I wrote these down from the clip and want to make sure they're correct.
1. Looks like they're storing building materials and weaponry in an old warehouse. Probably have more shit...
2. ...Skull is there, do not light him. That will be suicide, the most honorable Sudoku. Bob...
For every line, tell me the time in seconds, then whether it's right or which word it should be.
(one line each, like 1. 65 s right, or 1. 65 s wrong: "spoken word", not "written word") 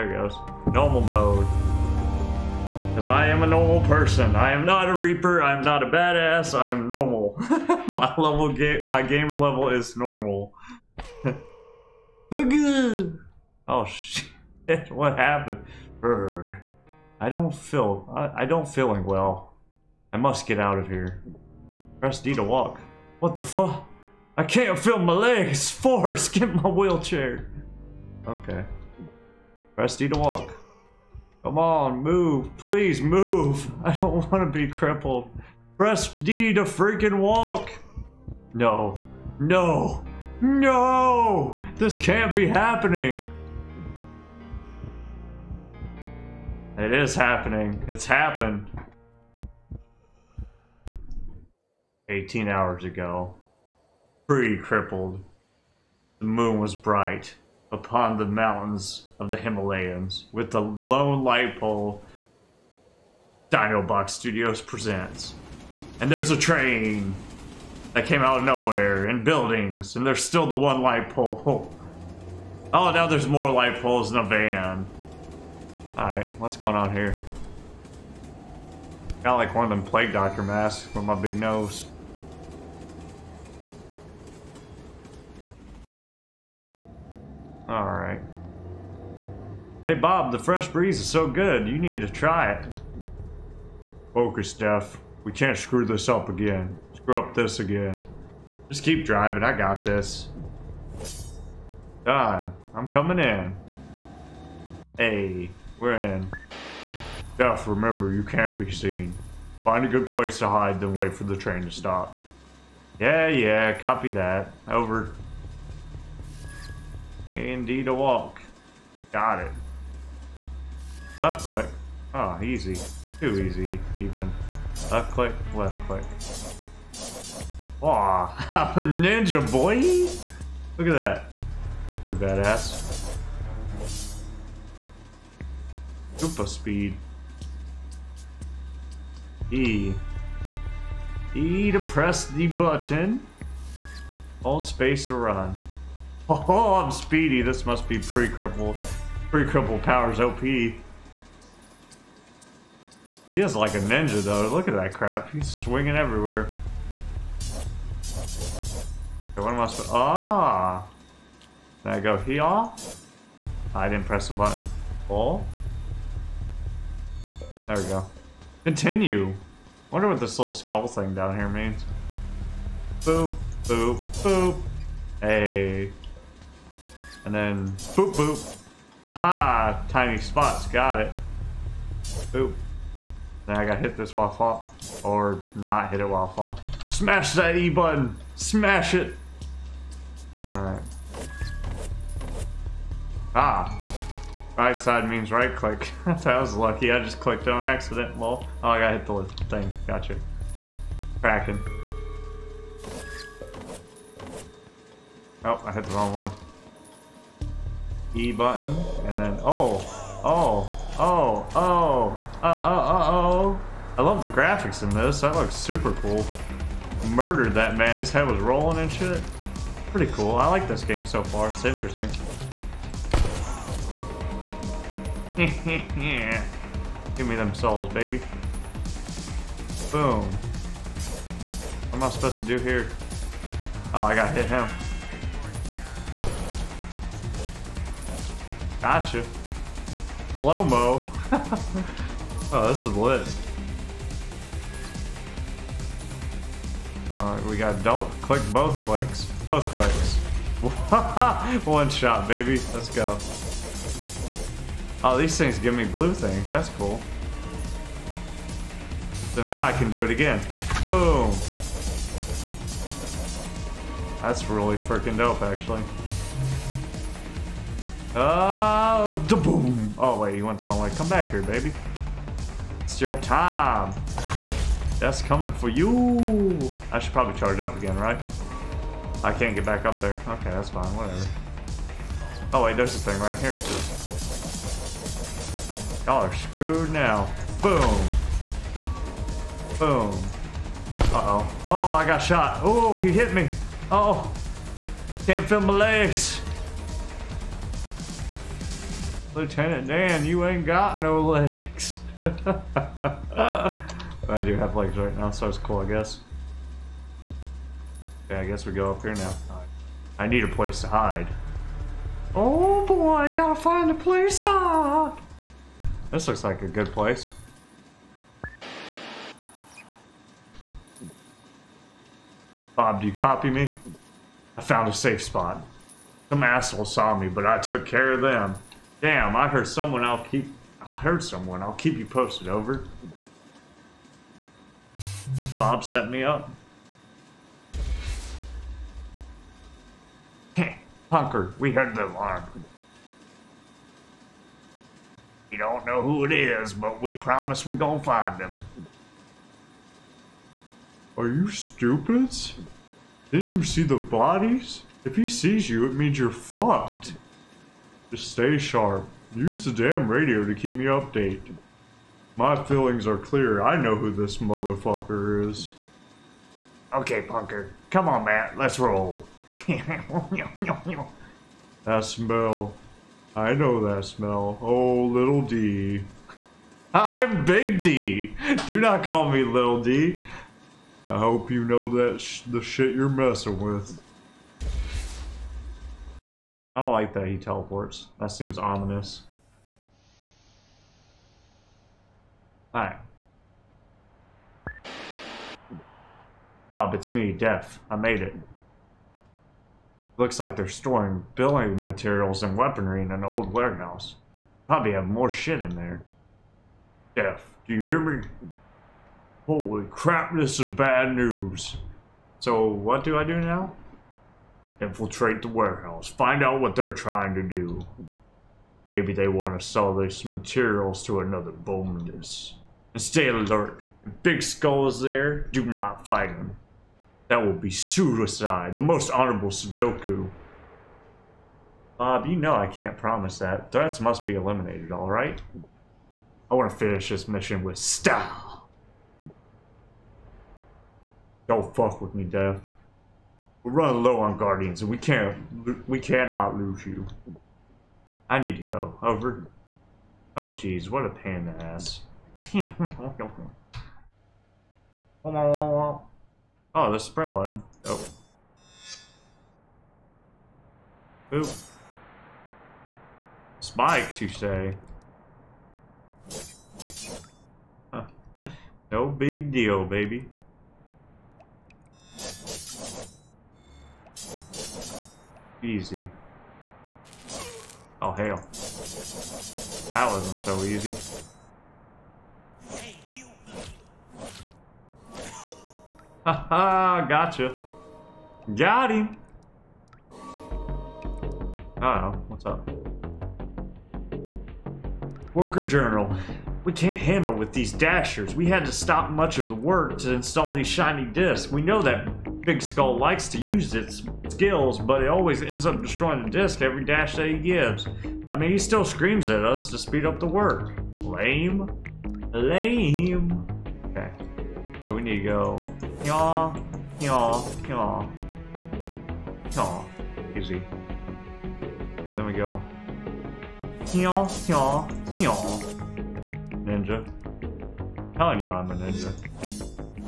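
1. 400 s right
2. 424 s wrong: "fight", not "light".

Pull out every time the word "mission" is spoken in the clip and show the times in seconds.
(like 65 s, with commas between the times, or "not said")
437 s.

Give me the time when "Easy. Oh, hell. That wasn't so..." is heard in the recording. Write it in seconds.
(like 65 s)
475 s.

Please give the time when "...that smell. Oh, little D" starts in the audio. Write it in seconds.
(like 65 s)
373 s.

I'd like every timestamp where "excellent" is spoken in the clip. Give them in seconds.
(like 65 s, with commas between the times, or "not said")
not said.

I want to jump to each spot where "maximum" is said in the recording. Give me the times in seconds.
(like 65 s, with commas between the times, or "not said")
not said.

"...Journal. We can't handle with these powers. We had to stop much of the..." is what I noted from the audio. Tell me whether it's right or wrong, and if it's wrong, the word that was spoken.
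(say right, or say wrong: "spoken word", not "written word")
wrong: "dashers", not "powers".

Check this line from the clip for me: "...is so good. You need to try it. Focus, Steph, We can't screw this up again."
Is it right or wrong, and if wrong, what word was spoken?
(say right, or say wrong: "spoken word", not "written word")
right.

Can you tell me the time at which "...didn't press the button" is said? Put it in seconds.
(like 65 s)
163 s.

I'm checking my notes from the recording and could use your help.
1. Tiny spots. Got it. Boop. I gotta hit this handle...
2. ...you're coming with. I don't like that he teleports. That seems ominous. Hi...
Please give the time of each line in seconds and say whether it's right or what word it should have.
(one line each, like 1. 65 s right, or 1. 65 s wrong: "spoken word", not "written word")
1. 179 s wrong: "while", not "handle"
2. 382 s wrong: "messing", not "coming".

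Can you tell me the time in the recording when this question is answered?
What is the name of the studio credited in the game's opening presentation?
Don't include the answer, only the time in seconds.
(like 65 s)
63 s.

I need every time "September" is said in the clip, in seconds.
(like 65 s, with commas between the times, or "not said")
not said.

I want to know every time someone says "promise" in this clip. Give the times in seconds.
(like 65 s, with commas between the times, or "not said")
347 s, 432 s.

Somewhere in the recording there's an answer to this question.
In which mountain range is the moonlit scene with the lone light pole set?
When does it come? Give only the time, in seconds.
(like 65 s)
59 s.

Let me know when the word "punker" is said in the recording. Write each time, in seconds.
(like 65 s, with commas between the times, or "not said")
341 s, 367 s.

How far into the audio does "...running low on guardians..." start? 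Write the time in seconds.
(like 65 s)
443 s.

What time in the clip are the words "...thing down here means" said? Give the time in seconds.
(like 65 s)
170 s.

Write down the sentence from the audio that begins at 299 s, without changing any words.
Lieutenant Dan, you ain't got no legs.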